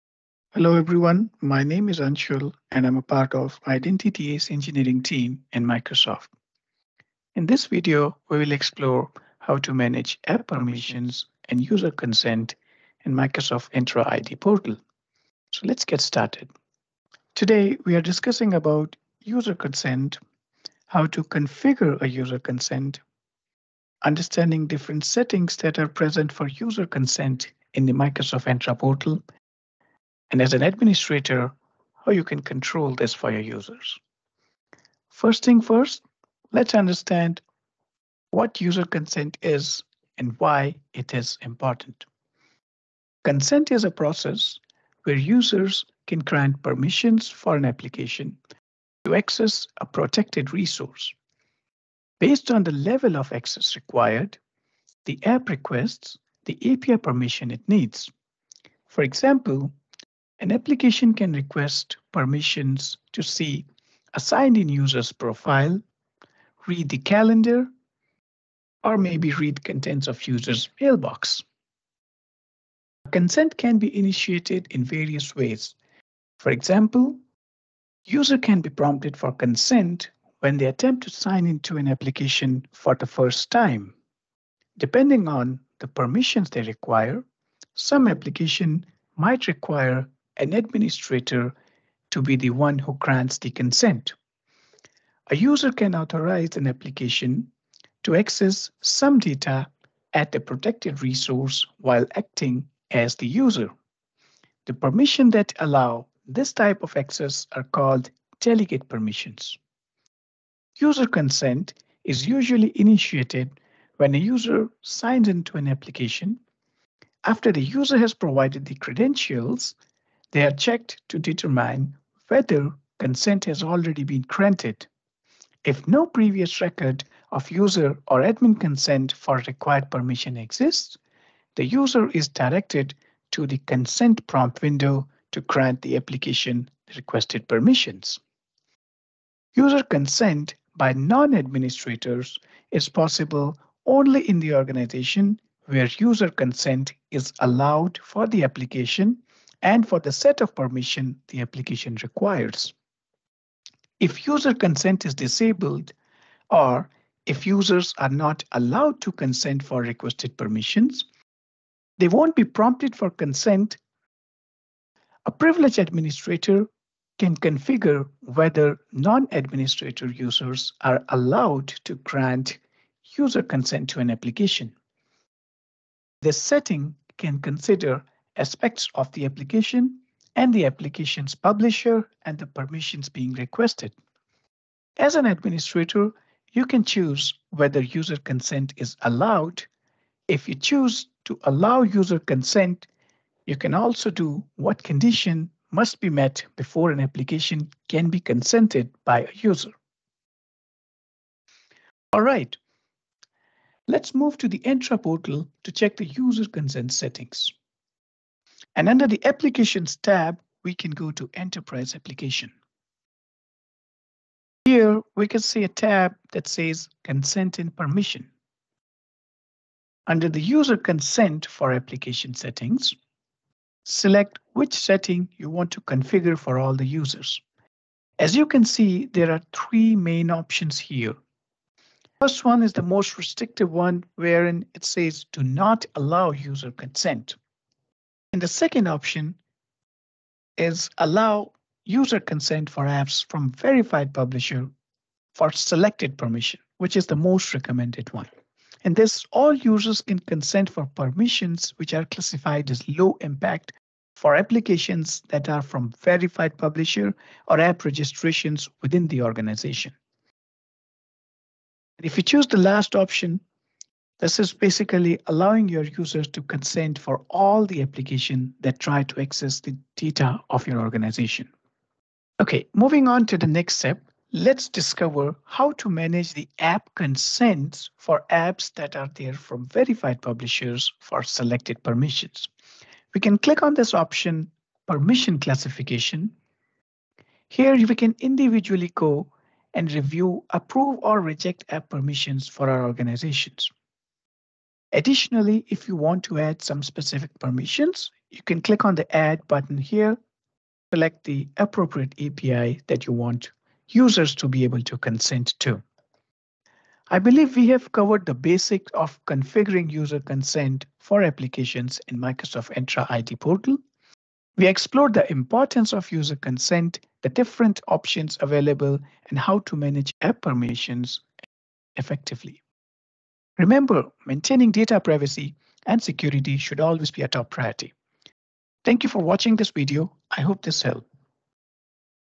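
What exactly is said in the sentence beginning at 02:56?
This setting can consider aspects of the application and the application's publisher and the permissions being requested.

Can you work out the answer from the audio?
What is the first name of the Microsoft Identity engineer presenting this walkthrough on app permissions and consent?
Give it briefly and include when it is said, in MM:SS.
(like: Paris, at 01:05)
Anshul, at 00:02.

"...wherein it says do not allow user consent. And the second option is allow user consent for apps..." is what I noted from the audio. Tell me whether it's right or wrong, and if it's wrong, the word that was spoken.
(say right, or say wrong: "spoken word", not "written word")
right.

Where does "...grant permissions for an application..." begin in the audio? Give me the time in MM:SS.
00:46.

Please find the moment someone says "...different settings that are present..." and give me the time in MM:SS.
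00:24.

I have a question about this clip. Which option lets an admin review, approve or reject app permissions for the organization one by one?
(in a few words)
permission classification.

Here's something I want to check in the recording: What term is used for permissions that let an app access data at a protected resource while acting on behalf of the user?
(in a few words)
delegate permissions.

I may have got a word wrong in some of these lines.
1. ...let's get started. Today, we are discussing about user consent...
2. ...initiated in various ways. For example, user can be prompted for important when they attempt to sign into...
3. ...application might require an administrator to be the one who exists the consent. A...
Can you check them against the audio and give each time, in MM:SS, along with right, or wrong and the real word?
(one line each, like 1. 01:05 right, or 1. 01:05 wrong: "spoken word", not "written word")
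1. 00:15 right
2. 01:13 wrong: "consent", not "important"
3. 01:28 wrong: "grants", not "exists".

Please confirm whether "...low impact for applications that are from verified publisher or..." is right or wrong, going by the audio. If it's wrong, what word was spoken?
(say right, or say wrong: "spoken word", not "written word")
right.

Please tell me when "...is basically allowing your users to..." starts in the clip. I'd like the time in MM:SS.
04:24.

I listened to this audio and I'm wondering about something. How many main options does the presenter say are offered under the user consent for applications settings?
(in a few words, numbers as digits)
3.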